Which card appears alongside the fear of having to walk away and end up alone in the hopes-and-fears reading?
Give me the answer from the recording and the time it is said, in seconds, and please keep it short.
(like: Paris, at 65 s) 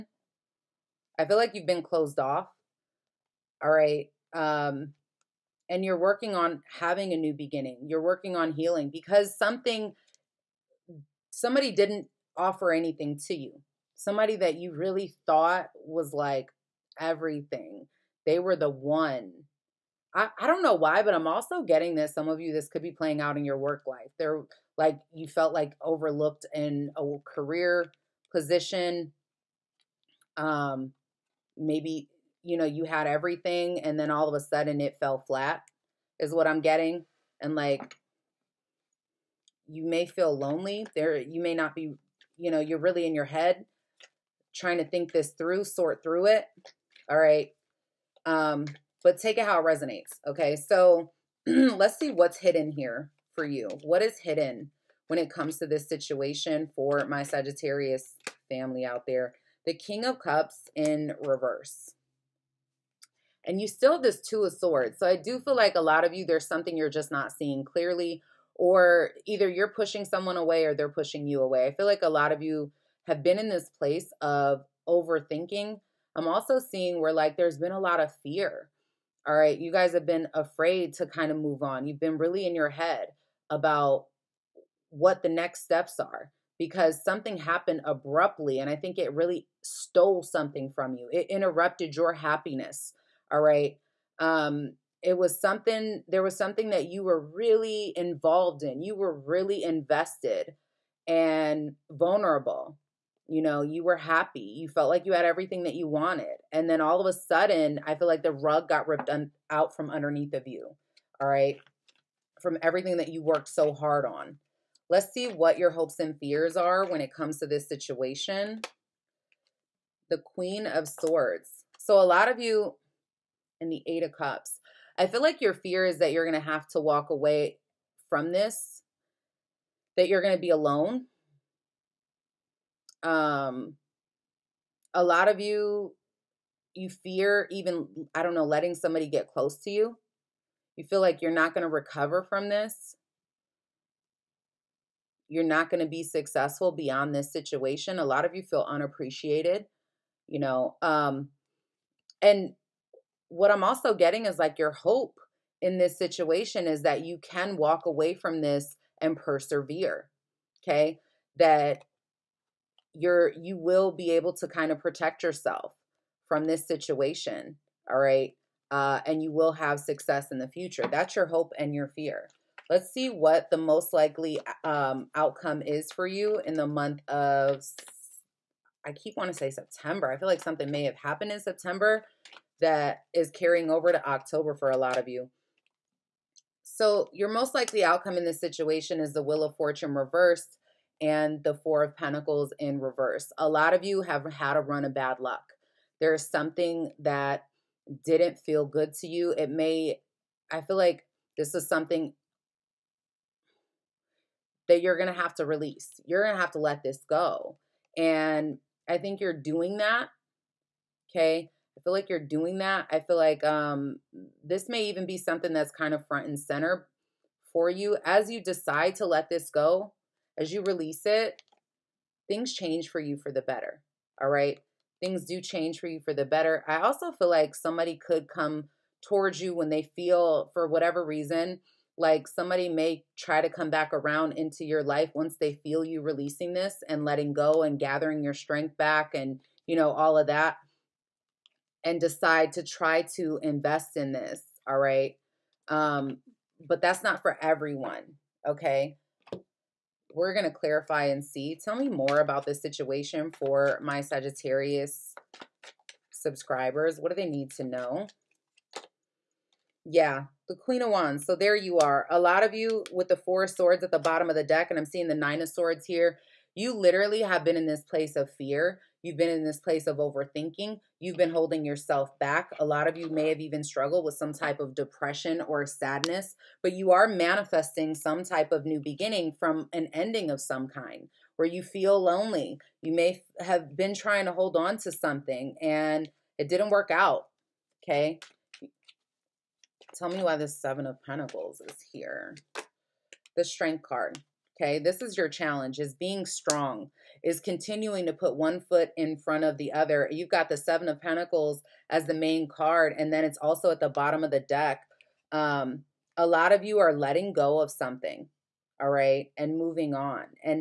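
Eight of Cups, at 123 s.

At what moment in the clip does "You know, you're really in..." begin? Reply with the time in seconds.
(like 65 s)
42 s.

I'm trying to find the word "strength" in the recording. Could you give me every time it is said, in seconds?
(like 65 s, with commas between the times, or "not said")
238 s, 293 s.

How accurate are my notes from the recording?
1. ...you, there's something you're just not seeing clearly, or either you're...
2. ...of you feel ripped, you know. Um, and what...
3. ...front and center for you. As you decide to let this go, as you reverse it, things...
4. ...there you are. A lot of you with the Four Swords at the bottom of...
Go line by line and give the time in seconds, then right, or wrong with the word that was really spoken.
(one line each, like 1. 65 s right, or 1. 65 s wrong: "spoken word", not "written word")
1. 66 s right
2. 148 s wrong: "unappreciated", not "ripped"
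3. 216 s wrong: "release", not "reverse"
4. 261 s right.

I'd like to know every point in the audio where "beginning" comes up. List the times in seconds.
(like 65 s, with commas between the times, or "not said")
7 s, 278 s.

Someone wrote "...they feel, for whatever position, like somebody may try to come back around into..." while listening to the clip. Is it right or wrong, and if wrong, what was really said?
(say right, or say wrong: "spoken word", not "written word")
wrong: "reason", not "position".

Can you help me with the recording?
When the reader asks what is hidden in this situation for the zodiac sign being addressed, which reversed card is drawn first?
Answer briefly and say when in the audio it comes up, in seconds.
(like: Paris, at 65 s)
King of Cups, at 59 s.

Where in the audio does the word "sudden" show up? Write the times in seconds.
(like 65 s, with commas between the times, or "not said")
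34 s, 107 s.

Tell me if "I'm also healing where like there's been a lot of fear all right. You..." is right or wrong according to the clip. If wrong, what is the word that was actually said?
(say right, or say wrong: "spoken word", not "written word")
wrong: "seeing", not "healing".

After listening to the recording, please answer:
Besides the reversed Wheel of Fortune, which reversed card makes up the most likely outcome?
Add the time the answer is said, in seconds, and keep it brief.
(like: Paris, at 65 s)
Four of Pentacles, at 191 s.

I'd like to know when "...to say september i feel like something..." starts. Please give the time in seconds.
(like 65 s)
179 s.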